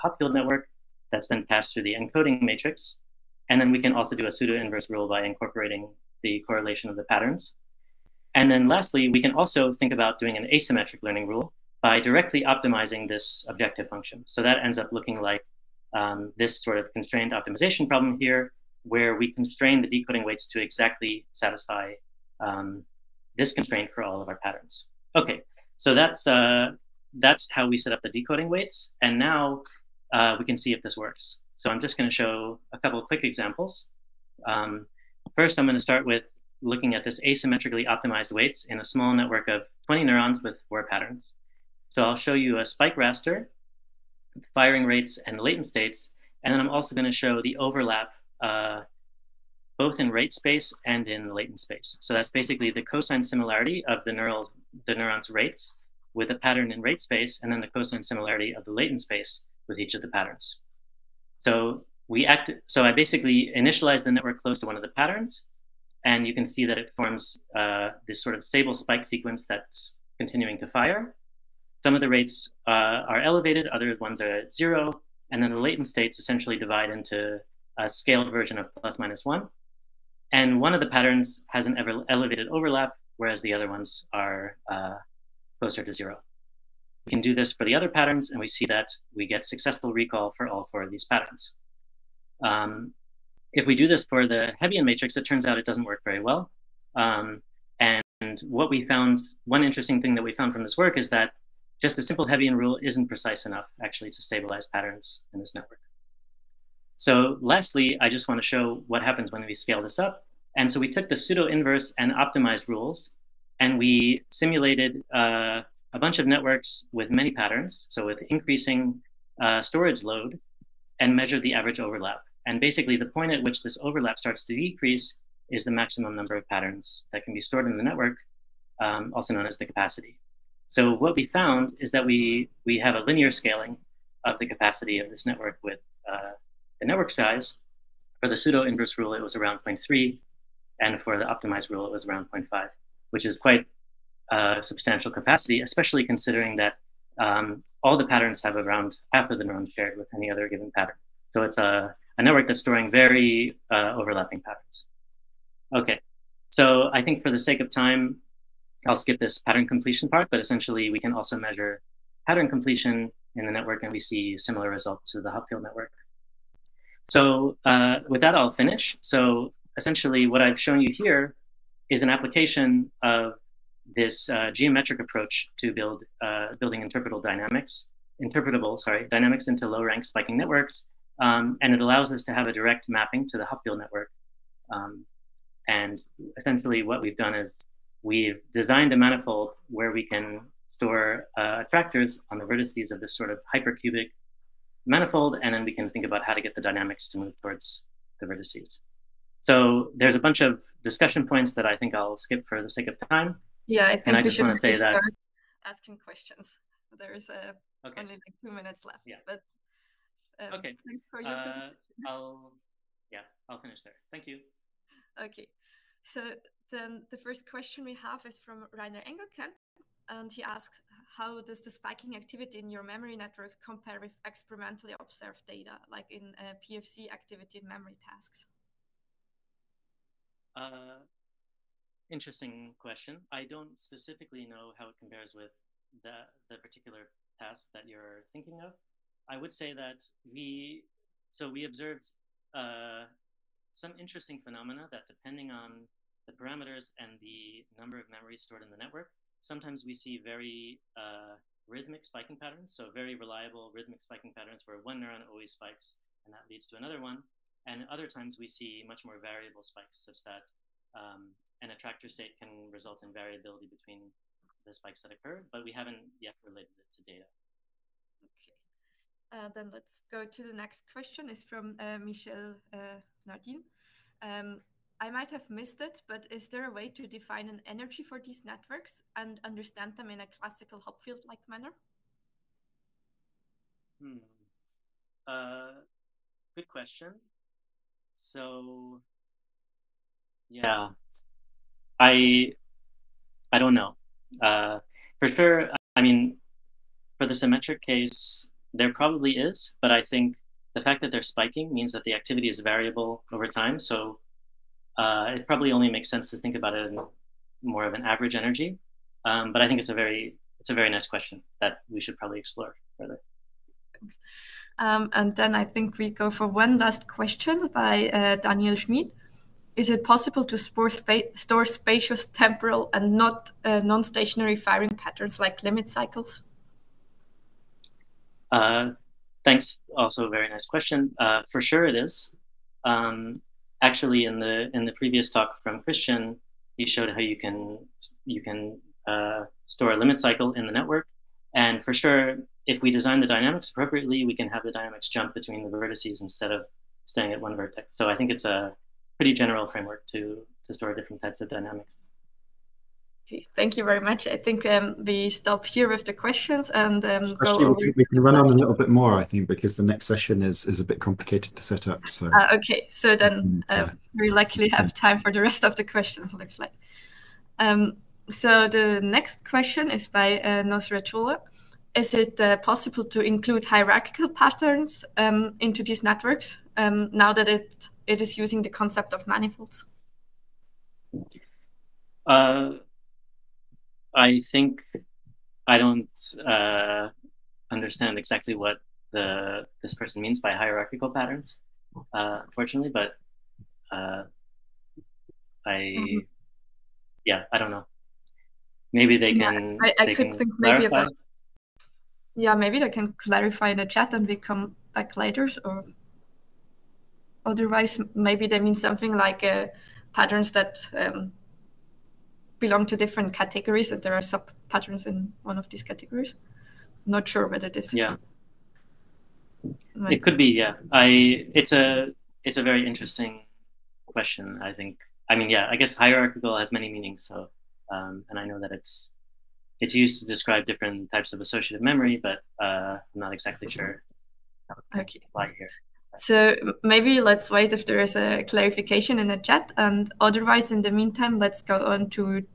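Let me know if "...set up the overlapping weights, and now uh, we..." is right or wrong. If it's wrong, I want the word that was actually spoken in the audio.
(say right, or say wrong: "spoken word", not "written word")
wrong: "decoding", not "overlapping".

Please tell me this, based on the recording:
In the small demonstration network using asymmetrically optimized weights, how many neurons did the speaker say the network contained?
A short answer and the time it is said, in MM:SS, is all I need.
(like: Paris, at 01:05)
20, at 00:39.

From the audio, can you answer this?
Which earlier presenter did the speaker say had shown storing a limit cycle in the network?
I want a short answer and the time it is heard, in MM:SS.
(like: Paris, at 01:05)
Christian, at 05:35.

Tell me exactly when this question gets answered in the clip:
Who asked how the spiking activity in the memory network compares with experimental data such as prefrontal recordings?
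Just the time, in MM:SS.
03:38.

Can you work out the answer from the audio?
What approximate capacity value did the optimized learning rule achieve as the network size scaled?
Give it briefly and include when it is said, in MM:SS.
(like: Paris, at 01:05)
0.5, at 02:22.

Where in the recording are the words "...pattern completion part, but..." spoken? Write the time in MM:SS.
02:39.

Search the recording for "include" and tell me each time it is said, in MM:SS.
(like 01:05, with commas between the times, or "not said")
06:13.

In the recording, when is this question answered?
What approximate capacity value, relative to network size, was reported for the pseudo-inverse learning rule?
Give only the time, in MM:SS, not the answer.
02:19.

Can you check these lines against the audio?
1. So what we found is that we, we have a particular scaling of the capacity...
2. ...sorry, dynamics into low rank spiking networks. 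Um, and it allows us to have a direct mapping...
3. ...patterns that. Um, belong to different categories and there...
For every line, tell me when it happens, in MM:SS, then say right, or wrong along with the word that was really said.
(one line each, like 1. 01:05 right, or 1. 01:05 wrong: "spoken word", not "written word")
1. 02:10 wrong: "linear", not "particular"
2. 02:58 right
3. 06:50 right.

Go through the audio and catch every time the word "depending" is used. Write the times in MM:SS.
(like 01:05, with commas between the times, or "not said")
04:05.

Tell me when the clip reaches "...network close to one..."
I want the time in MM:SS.
01:04.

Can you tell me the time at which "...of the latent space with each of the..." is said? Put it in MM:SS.
00:58.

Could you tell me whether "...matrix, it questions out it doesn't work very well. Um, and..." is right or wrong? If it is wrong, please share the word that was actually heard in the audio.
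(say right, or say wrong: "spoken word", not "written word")
wrong: "turns", not "questions".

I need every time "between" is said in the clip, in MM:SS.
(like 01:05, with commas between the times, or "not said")
04:23, 05:45.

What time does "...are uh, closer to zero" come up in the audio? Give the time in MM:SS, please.
01:24.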